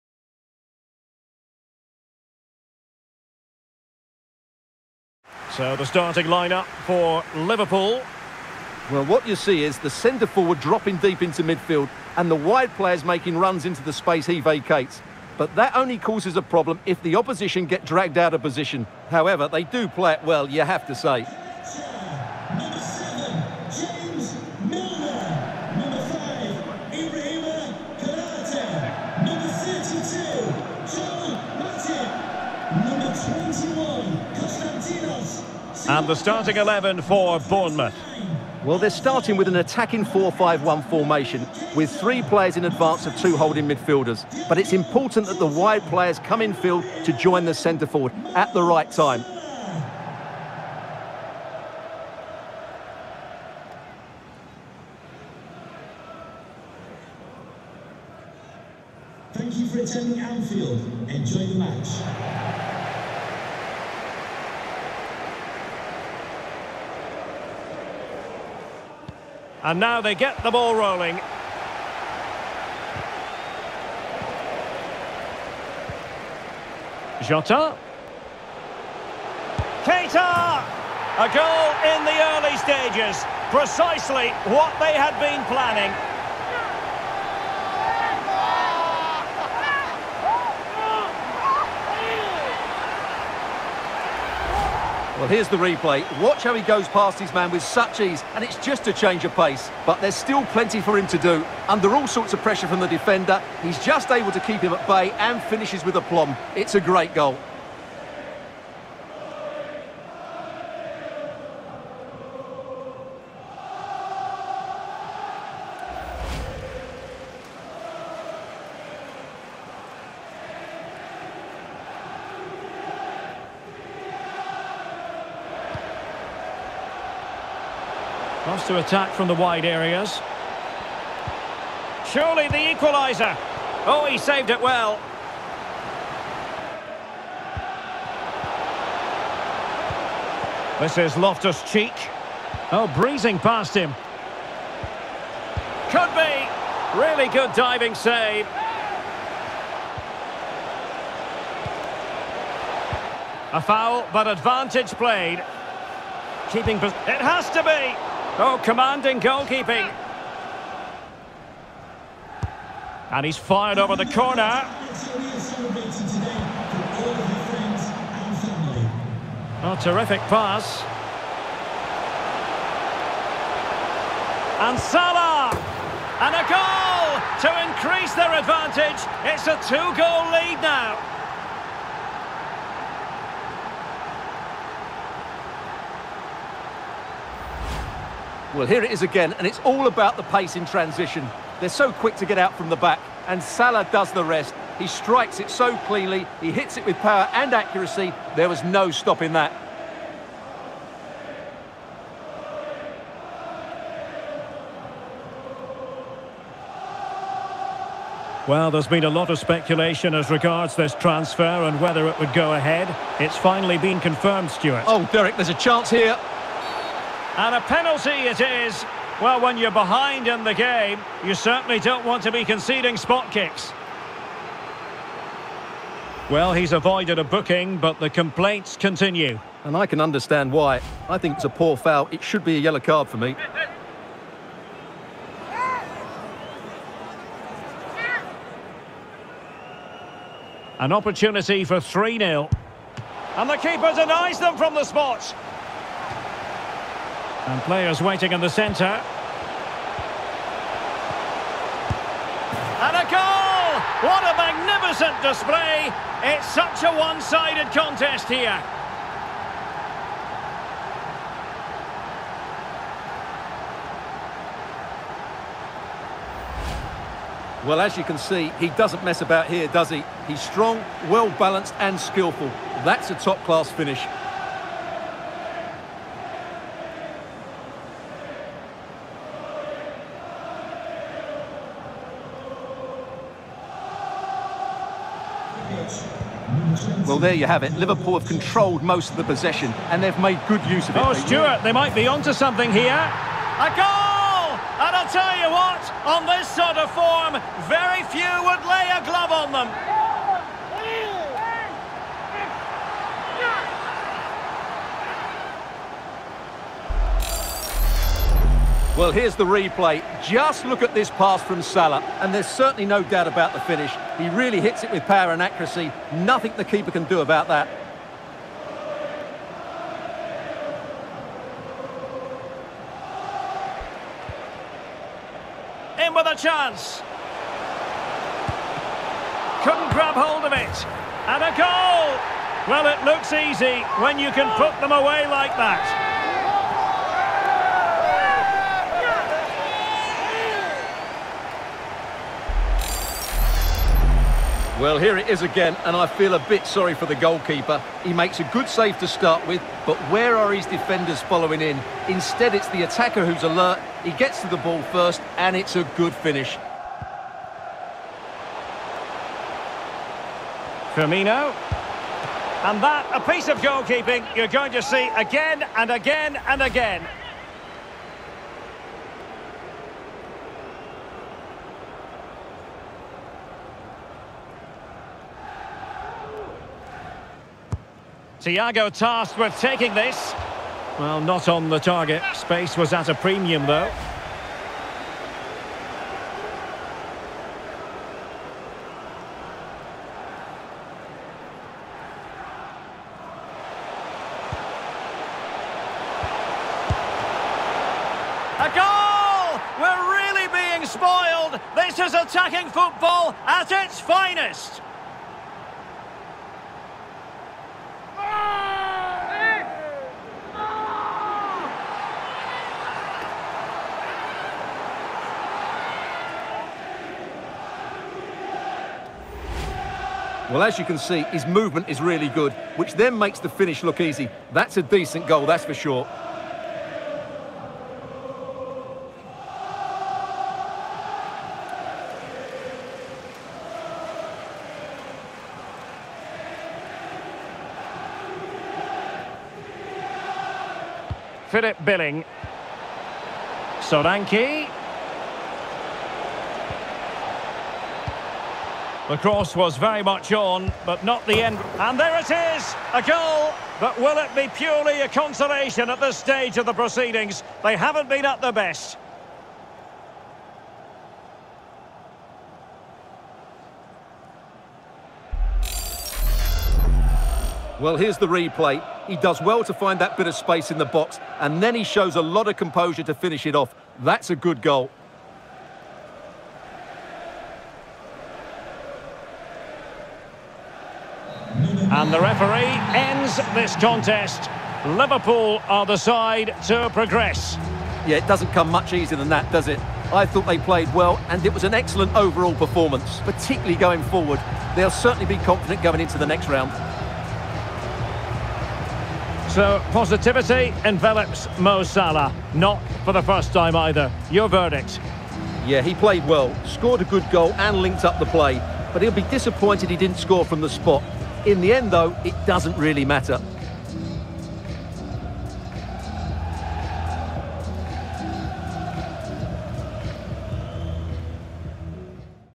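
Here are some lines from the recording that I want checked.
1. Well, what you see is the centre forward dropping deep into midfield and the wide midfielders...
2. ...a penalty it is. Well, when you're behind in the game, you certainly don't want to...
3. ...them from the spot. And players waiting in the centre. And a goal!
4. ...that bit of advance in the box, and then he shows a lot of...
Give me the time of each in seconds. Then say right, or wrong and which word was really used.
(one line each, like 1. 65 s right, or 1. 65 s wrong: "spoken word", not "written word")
1. 8 s wrong: "players", not "midfielders"
2. 217 s right
3. 244 s right
4. 469 s wrong: "space", not "advance".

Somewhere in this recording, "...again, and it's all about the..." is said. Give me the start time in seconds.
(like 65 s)
189 s.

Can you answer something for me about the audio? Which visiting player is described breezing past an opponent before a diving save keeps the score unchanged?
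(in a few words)
Loftus-Cheek.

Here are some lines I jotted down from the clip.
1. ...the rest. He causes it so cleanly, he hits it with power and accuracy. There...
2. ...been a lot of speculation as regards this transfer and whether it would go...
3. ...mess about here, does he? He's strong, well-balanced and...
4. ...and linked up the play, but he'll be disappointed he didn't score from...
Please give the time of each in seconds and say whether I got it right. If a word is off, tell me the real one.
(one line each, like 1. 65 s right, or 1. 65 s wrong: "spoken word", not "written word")
1. 194 s wrong: "strikes", not "causes"
2. 208 s right
3. 269 s right
4. 507 s right.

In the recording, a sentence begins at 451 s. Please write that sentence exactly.
And there it is, a goal.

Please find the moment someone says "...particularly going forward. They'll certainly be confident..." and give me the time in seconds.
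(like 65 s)
493 s.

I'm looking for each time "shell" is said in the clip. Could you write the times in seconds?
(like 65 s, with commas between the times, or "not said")
not said.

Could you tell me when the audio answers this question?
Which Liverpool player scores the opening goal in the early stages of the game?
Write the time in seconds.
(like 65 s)
79 s.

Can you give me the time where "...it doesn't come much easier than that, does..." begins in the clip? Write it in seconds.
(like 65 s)
488 s.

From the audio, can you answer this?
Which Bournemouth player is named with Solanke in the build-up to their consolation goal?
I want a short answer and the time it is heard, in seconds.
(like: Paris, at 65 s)
Philip Billing, at 441 s.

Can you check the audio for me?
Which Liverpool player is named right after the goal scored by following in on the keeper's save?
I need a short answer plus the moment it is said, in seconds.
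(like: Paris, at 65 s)
Firmino, at 360 s.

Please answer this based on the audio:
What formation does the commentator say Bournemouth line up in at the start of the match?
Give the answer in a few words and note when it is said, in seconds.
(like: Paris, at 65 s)
4-5-1, at 40 s.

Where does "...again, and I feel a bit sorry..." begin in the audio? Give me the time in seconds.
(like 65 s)
345 s.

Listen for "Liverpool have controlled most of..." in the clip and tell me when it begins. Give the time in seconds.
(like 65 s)
287 s.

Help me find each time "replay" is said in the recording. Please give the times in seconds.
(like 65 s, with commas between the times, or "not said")
95 s, 309 s, 468 s.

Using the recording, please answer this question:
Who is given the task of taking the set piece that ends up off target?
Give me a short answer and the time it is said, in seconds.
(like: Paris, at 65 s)
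Thiago, at 378 s.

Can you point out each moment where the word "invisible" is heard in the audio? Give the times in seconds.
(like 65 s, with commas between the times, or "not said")
not said.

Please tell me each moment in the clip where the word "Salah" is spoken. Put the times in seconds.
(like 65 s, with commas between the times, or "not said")
174 s, 193 s, 311 s, 501 s.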